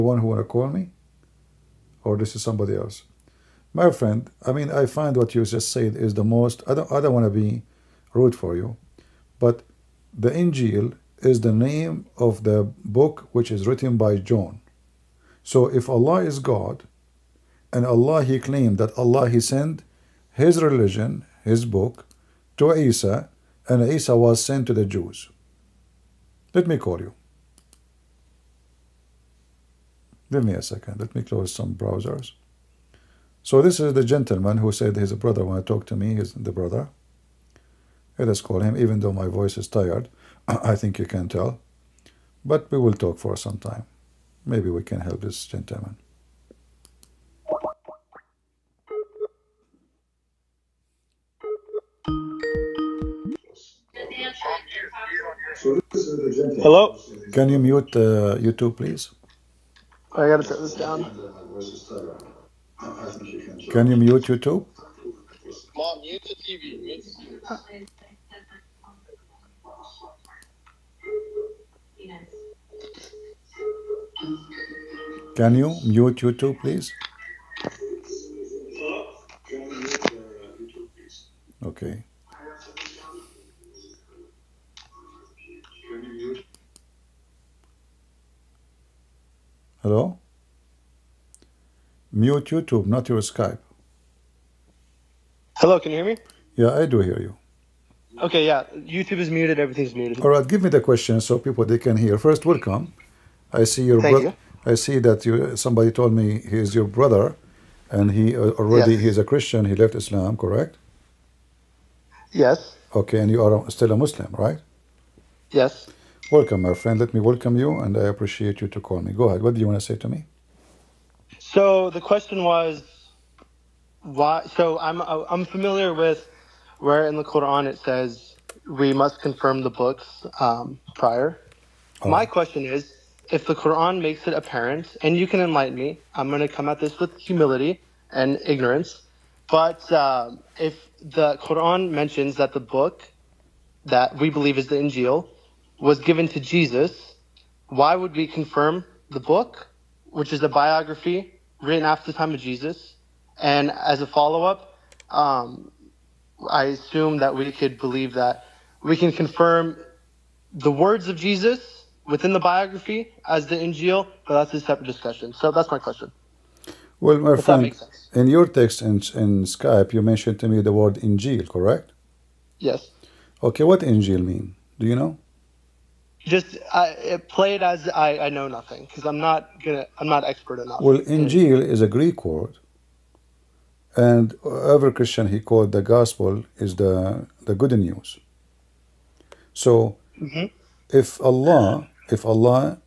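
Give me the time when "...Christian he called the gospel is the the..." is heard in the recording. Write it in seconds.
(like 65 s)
184 s.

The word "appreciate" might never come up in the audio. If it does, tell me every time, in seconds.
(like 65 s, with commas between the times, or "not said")
118 s.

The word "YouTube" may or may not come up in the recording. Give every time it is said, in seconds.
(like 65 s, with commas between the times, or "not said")
58 s, 64 s, 76 s, 92 s, 98 s.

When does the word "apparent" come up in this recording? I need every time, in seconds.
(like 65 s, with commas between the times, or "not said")
134 s.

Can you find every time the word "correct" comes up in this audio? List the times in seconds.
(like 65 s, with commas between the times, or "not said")
110 s, 171 s.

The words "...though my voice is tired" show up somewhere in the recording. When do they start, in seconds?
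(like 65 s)
39 s.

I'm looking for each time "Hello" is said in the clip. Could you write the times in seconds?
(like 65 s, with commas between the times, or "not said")
56 s, 89 s, 95 s.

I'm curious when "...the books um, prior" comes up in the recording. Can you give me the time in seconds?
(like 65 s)
129 s.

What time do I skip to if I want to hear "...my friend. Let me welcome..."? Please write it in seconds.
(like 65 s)
116 s.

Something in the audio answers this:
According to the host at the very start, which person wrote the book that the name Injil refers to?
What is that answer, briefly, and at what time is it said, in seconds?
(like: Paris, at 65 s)
John, at 14 s.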